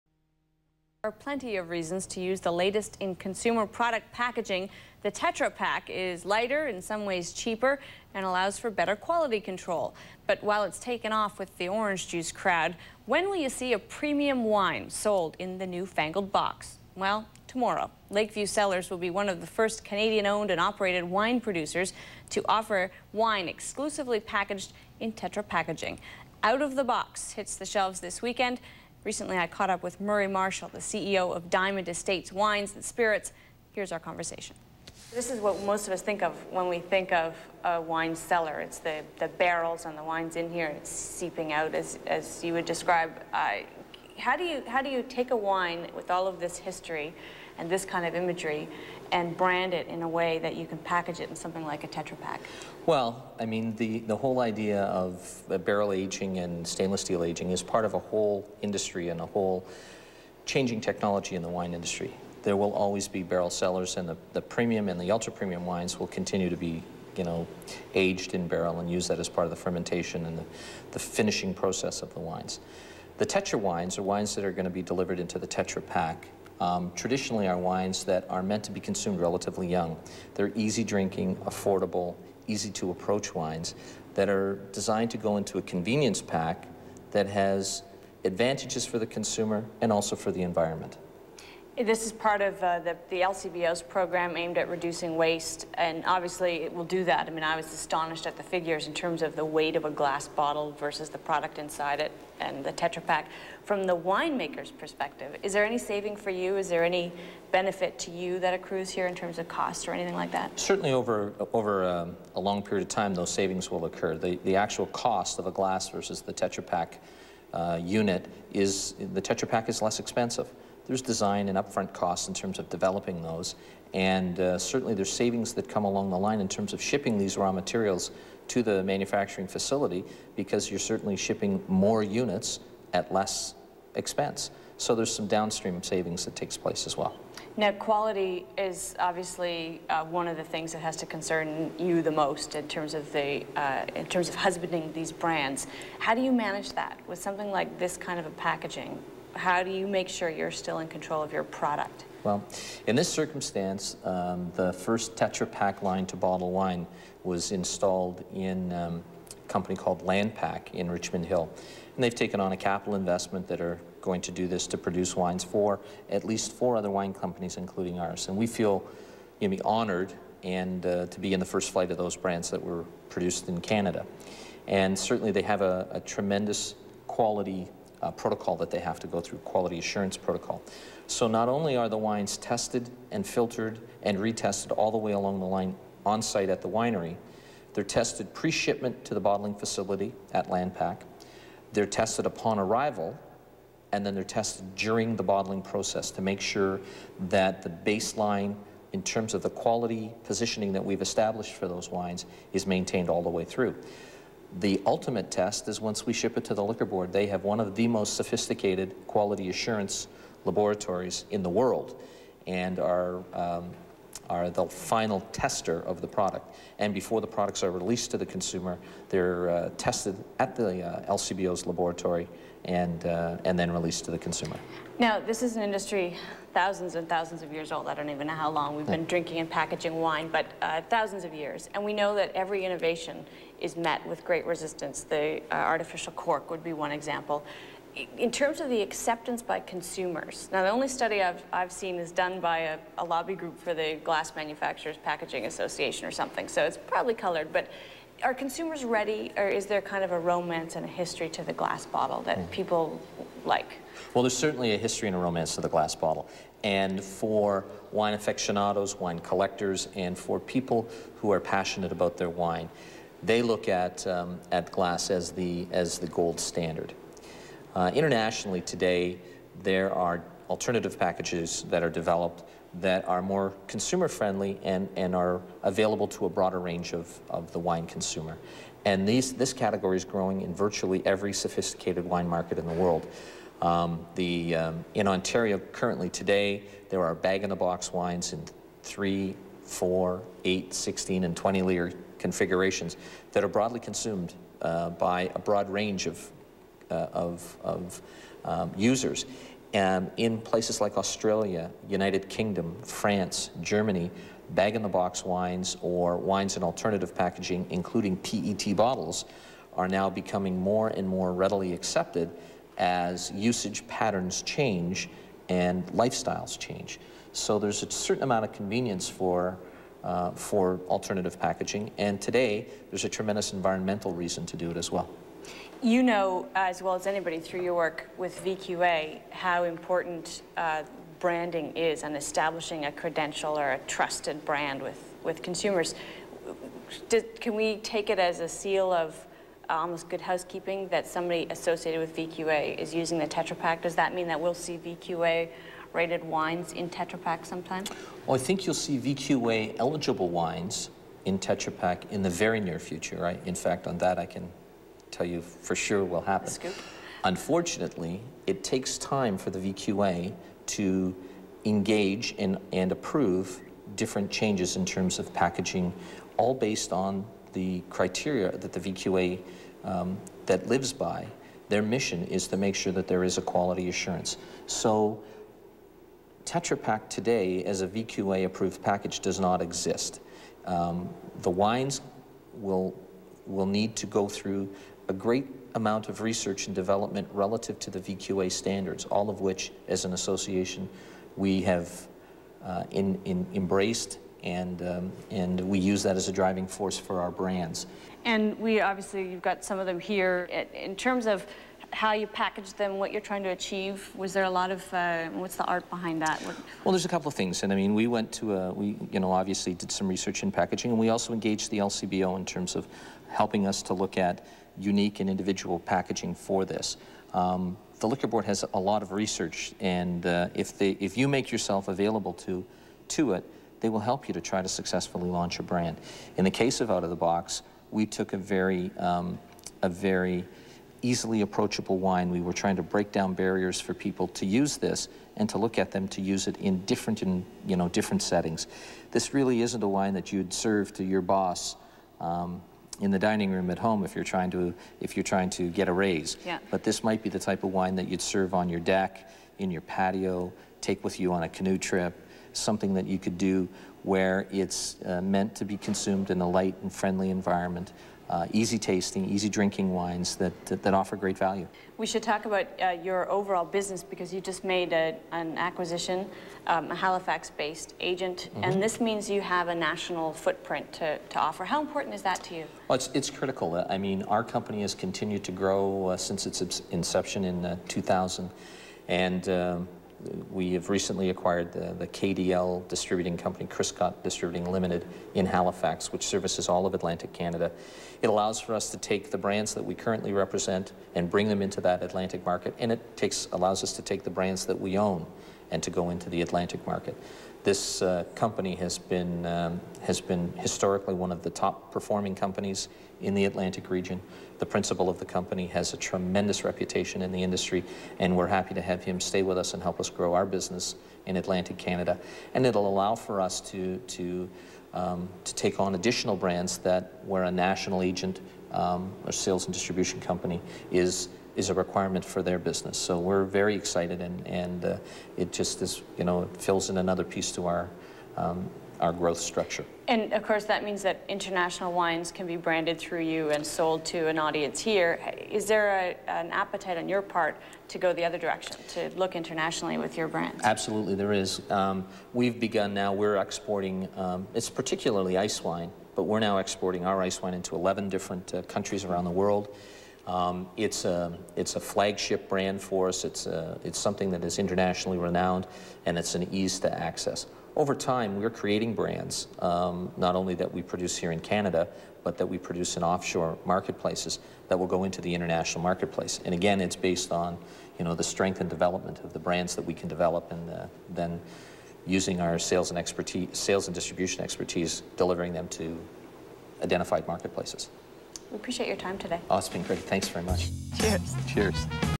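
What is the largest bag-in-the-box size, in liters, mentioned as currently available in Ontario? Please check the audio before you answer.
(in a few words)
20 liters.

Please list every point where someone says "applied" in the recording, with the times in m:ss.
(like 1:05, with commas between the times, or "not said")
not said.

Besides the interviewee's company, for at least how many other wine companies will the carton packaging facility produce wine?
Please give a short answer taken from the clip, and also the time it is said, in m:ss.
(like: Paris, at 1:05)
4, at 2:46.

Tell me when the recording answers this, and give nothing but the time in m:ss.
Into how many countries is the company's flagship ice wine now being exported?
9:07.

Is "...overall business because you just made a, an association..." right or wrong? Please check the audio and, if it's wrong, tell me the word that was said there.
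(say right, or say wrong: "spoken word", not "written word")
wrong: "acquisition", not "association".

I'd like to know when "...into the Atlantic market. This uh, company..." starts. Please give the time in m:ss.
8:16.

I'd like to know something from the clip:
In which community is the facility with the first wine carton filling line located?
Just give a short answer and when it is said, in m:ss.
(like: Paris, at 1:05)
Richmond Hill, at 2:40.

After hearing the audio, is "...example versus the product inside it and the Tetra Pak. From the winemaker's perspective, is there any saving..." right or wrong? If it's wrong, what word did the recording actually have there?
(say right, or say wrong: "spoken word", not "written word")
wrong: "bottle", not "example".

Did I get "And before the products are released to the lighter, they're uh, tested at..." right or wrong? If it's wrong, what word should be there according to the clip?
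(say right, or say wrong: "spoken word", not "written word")
wrong: "consumer", not "lighter".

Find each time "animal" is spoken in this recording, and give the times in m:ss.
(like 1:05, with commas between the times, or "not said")
not said.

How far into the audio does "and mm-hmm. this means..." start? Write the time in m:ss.
7:48.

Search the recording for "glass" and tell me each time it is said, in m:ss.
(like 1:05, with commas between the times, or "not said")
1:39, 1:55, 4:04, 4:11, 4:15, 4:24.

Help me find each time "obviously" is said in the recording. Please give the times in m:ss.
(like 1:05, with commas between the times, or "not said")
1:36, 2:18, 6:38, 6:49.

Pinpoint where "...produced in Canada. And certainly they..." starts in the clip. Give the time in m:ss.
2:53.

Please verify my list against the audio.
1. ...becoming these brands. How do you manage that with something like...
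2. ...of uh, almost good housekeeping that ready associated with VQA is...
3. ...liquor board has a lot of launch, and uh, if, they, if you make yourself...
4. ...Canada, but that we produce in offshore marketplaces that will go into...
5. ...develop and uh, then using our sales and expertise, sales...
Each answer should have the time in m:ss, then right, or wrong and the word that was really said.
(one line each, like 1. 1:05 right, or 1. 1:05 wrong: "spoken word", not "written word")
1. 2:24 wrong: "husbanding", not "becoming"
2. 5:38 wrong: "somebody", not "ready"
3. 6:58 wrong: "research", not "launch"
4. 9:21 right
5. 9:30 right.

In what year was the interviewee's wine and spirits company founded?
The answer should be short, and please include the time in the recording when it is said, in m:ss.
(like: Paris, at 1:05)
2000, at 7:57.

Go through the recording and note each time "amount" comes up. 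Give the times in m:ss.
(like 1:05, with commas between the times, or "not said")
5:18, 6:25.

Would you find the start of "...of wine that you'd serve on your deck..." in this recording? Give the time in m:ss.
7:27.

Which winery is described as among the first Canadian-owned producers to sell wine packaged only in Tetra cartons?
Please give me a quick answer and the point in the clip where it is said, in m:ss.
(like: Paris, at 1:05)
Lakeview Cellars, at 0:18.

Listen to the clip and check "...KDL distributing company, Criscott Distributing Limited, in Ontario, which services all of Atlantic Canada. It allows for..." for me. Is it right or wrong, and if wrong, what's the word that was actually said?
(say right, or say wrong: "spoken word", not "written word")
wrong: "Halifax", not "Ontario".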